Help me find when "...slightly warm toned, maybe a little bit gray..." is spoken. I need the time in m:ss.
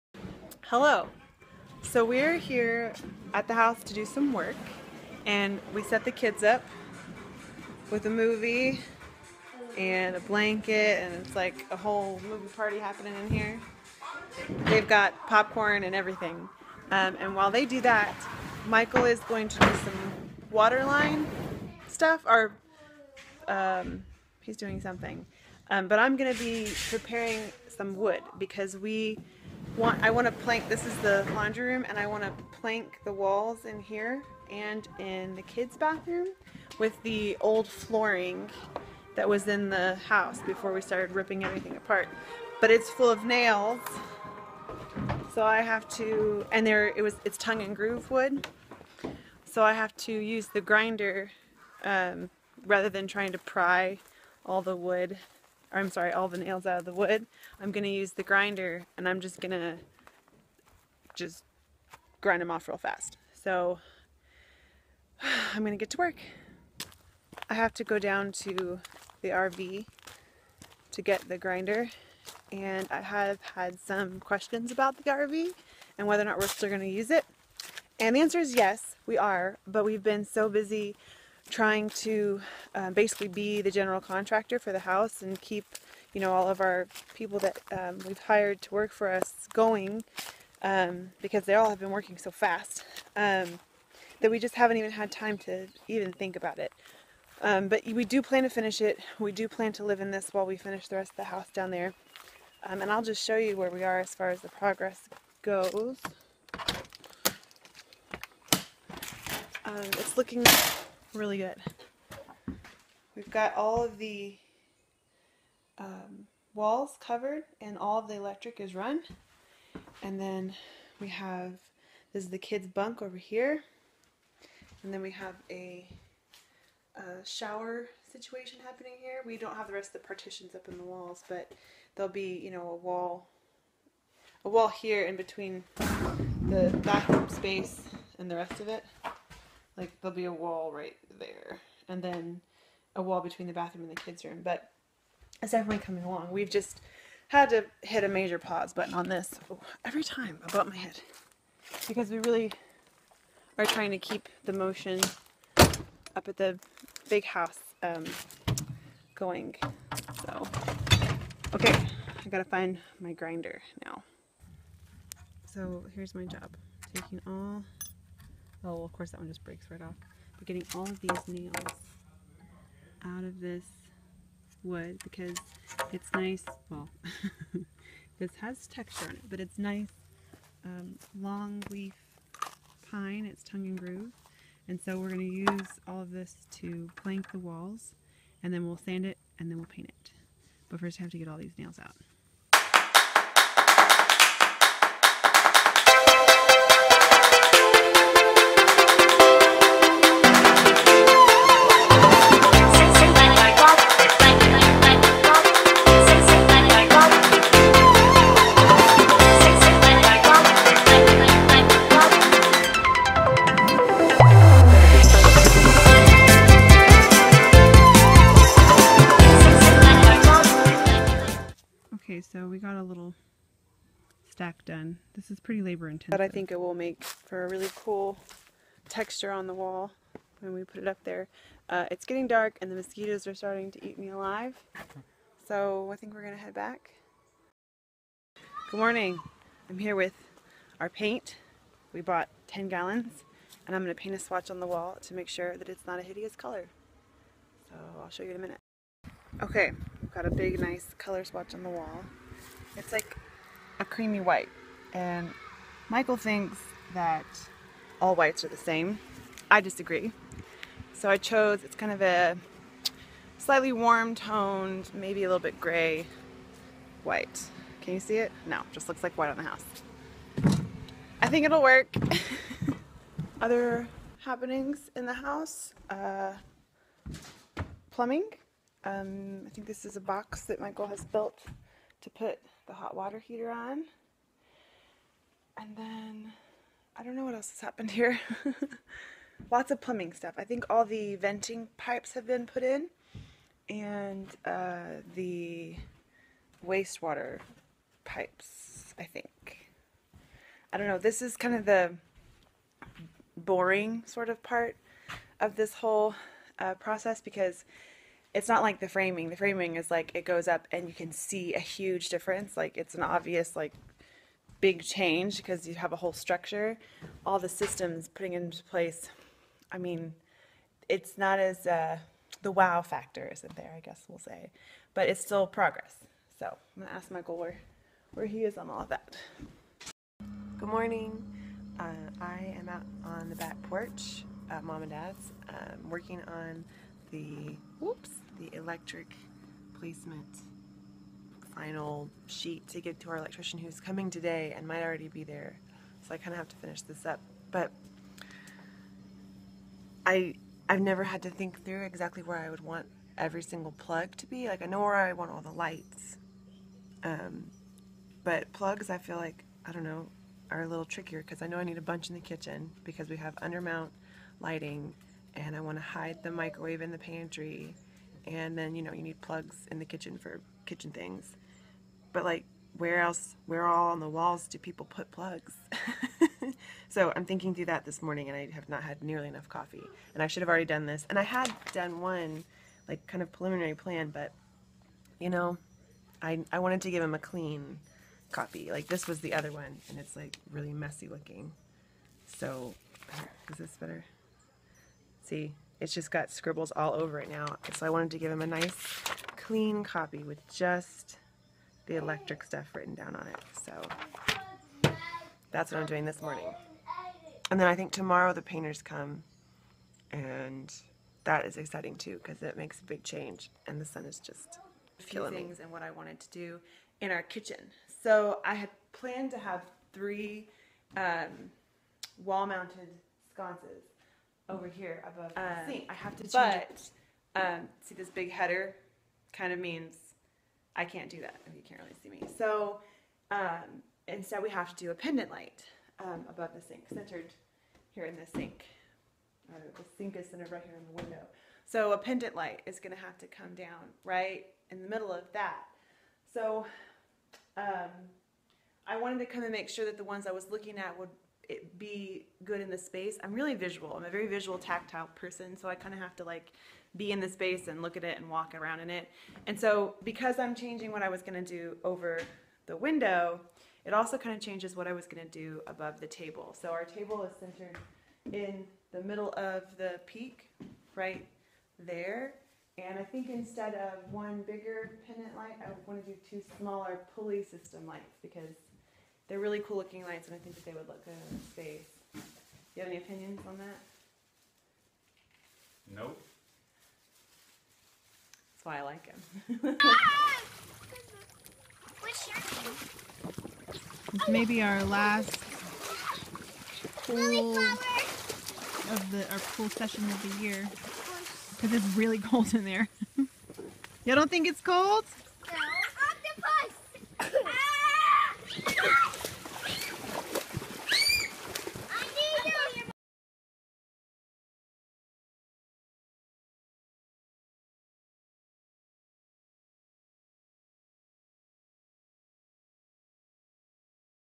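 4:23.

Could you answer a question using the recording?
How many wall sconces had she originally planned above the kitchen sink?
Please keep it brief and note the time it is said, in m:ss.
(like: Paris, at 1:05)
three, at 6:59.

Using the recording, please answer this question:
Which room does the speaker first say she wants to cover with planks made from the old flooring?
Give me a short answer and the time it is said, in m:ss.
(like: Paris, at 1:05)
laundry room, at 0:31.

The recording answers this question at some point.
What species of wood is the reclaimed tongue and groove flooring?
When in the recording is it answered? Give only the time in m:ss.
3:01.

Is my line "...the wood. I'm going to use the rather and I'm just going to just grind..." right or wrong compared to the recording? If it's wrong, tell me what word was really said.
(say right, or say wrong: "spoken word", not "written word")
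wrong: "grinder", not "rather".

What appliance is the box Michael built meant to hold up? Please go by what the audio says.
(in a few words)
hot water heater.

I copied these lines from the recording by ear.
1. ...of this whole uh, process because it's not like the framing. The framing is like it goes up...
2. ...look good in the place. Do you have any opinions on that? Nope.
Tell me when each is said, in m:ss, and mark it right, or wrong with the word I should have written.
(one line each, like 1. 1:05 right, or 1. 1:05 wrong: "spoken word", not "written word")
1. 5:05 right
2. 8:00 wrong: "space", not "place".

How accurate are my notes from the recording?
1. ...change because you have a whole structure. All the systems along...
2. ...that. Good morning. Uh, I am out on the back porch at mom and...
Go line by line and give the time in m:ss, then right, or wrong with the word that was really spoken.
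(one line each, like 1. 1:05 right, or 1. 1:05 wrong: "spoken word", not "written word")
1. 5:14 wrong: "putting", not "along"
2. 5:28 right.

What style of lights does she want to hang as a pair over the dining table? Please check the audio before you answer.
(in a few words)
pulley system lights.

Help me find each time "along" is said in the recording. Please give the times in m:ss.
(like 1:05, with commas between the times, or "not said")
2:26.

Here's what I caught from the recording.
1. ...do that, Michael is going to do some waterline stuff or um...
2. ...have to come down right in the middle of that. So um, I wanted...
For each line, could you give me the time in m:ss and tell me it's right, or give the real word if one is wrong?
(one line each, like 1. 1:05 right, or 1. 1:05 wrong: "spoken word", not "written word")
1. 0:17 right
2. 7:22 right.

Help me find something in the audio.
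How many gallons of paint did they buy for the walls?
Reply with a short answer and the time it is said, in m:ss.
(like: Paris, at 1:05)
10, at 4:02.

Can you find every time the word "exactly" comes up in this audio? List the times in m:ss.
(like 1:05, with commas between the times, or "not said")
5:51.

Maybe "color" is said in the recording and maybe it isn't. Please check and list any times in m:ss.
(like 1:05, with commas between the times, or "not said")
4:06, 4:10.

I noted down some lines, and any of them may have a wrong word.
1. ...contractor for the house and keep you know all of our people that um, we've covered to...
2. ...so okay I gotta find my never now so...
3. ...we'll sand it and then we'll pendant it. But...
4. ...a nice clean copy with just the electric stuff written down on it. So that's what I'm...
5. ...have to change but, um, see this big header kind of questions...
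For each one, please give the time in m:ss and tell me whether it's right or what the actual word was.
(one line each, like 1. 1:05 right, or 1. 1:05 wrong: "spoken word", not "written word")
1. 1:23 wrong: "hired", not "covered"
2. 2:40 wrong: "grinder", not "never"
3. 3:08 wrong: "paint", not "pendant"
4. 6:38 right
5. 7:05 wrong: "means", not "questions".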